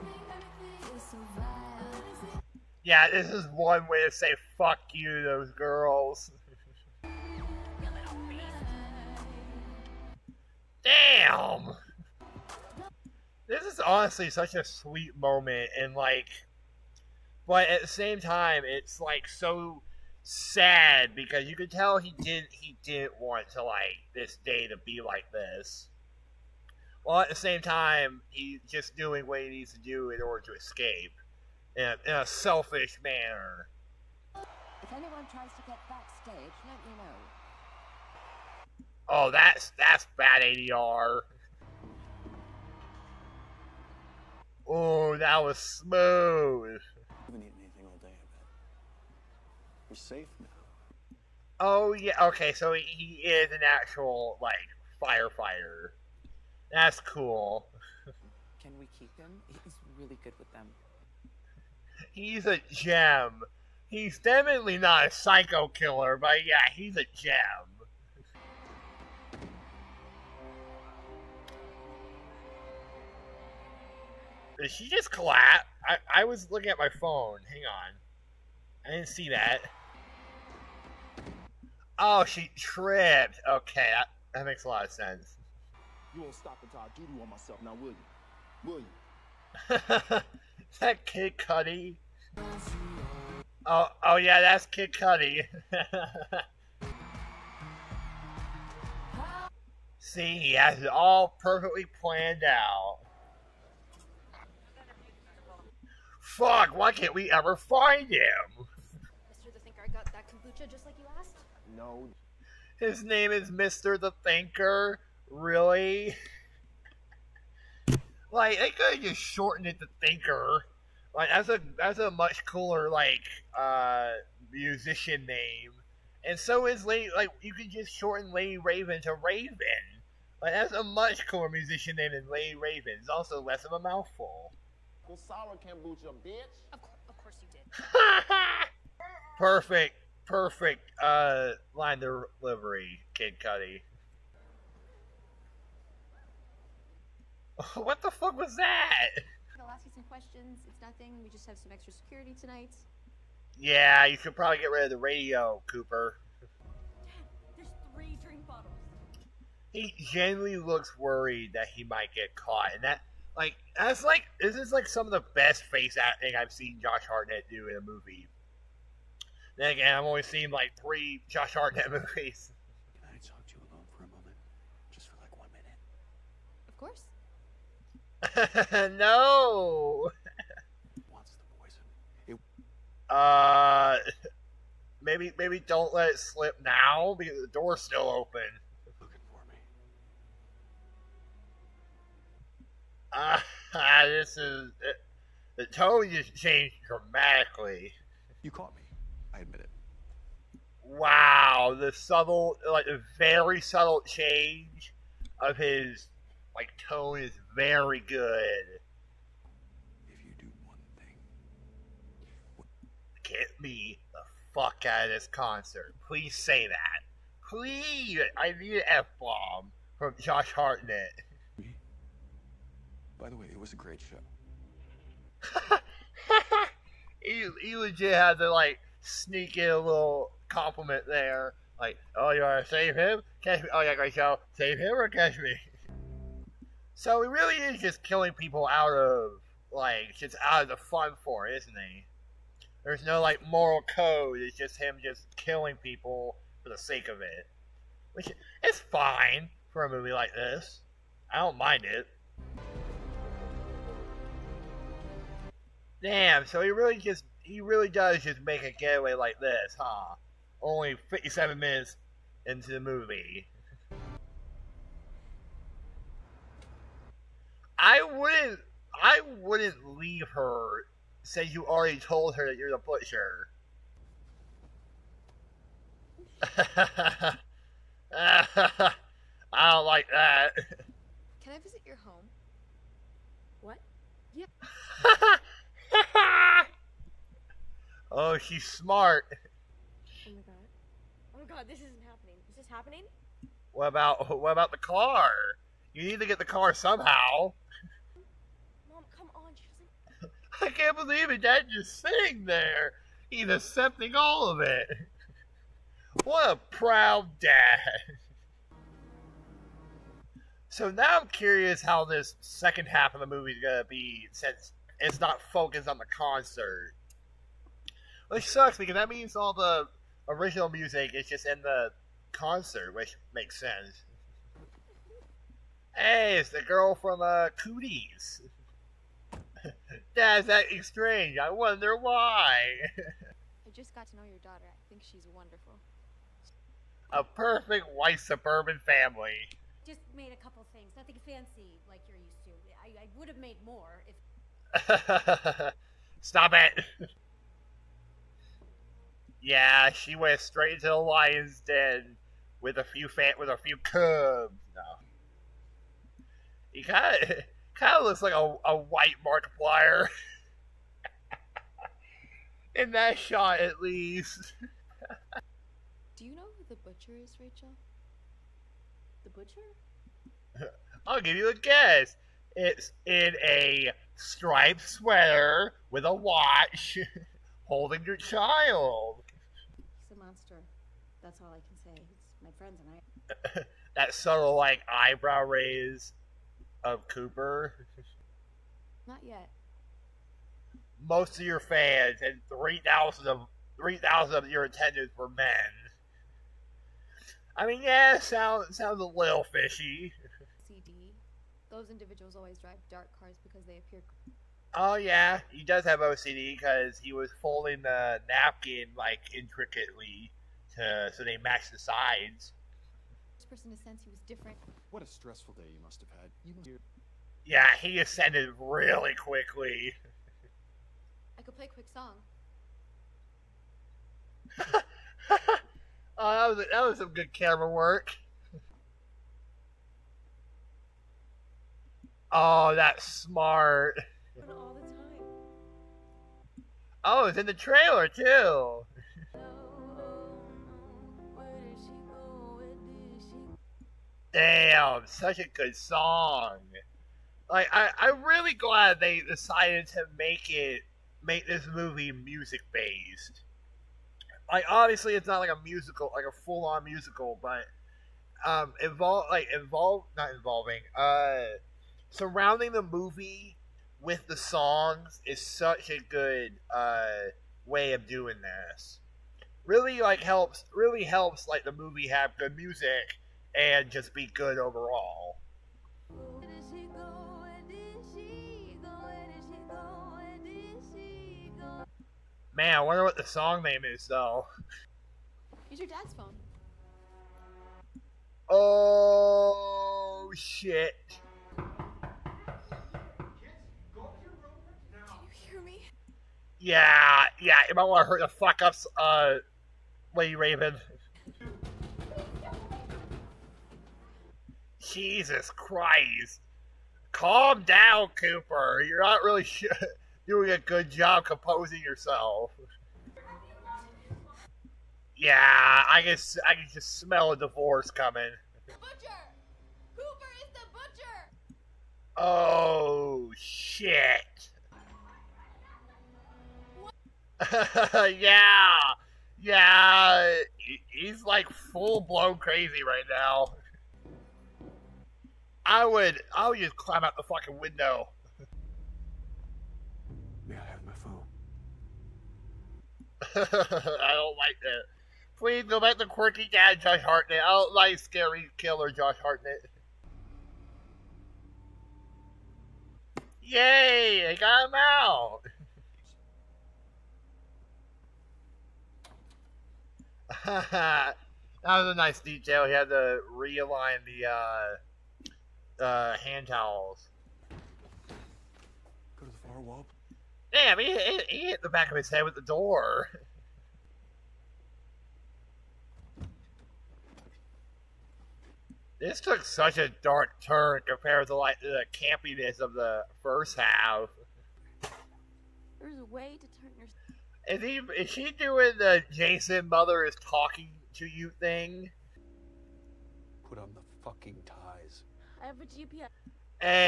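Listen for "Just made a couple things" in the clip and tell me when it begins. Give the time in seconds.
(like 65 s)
339 s.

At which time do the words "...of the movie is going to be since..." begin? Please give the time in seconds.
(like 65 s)
313 s.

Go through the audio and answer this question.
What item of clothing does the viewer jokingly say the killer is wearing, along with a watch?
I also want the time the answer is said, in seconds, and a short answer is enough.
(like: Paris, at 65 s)
Striped sweater, at 374 s.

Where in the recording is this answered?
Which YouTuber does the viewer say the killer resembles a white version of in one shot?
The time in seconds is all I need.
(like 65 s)
359 s.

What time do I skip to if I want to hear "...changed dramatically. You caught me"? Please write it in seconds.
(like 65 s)
196 s.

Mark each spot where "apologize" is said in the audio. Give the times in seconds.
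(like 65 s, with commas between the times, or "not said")
not said.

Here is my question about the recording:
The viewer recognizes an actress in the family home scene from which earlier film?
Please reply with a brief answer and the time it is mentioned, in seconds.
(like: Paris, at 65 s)
Cooties, at 327 s.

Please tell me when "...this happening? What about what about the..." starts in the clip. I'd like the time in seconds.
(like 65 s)
292 s.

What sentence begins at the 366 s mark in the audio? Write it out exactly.
Do you know who the butcher is, Rachel?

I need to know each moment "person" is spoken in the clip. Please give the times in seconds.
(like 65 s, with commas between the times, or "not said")
413 s.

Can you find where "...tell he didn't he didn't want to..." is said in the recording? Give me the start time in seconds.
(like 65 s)
21 s.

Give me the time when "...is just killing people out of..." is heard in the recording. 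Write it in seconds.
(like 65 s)
237 s.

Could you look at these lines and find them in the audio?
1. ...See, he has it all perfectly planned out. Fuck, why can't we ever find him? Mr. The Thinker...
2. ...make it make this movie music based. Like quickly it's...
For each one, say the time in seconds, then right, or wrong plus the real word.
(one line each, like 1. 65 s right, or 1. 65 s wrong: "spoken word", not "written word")
1. 99 s right
2. 450 s wrong: "obviously", not "quickly".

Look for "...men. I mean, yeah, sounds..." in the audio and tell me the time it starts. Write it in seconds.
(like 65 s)
395 s.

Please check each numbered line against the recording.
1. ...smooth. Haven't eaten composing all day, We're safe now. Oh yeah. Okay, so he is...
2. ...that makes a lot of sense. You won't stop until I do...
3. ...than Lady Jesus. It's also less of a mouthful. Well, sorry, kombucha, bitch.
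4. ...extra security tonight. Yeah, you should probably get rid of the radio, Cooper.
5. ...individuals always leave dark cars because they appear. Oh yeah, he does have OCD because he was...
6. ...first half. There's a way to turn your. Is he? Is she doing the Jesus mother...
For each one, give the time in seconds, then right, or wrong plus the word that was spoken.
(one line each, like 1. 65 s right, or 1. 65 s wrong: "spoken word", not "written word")
1. 45 s wrong: "anything", not "composing"
2. 84 s right
3. 132 s wrong: "Raven", not "Jesus"
4. 151 s right
5. 401 s wrong: "drive", not "leave"
6. 583 s wrong: "Jason", not "Jesus".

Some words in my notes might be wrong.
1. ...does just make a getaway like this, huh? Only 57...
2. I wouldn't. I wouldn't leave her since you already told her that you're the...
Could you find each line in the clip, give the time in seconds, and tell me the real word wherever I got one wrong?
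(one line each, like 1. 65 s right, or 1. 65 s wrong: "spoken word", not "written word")
1. 257 s right
2. 267 s right.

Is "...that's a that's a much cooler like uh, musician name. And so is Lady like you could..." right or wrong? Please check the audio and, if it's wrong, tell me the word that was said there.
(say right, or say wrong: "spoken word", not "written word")
right.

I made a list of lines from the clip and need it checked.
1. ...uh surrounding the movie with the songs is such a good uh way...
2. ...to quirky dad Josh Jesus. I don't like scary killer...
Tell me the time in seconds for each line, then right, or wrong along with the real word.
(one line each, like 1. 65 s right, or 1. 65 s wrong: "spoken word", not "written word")
1. 460 s right
2. 545 s wrong: "Hartnett", not "Jesus".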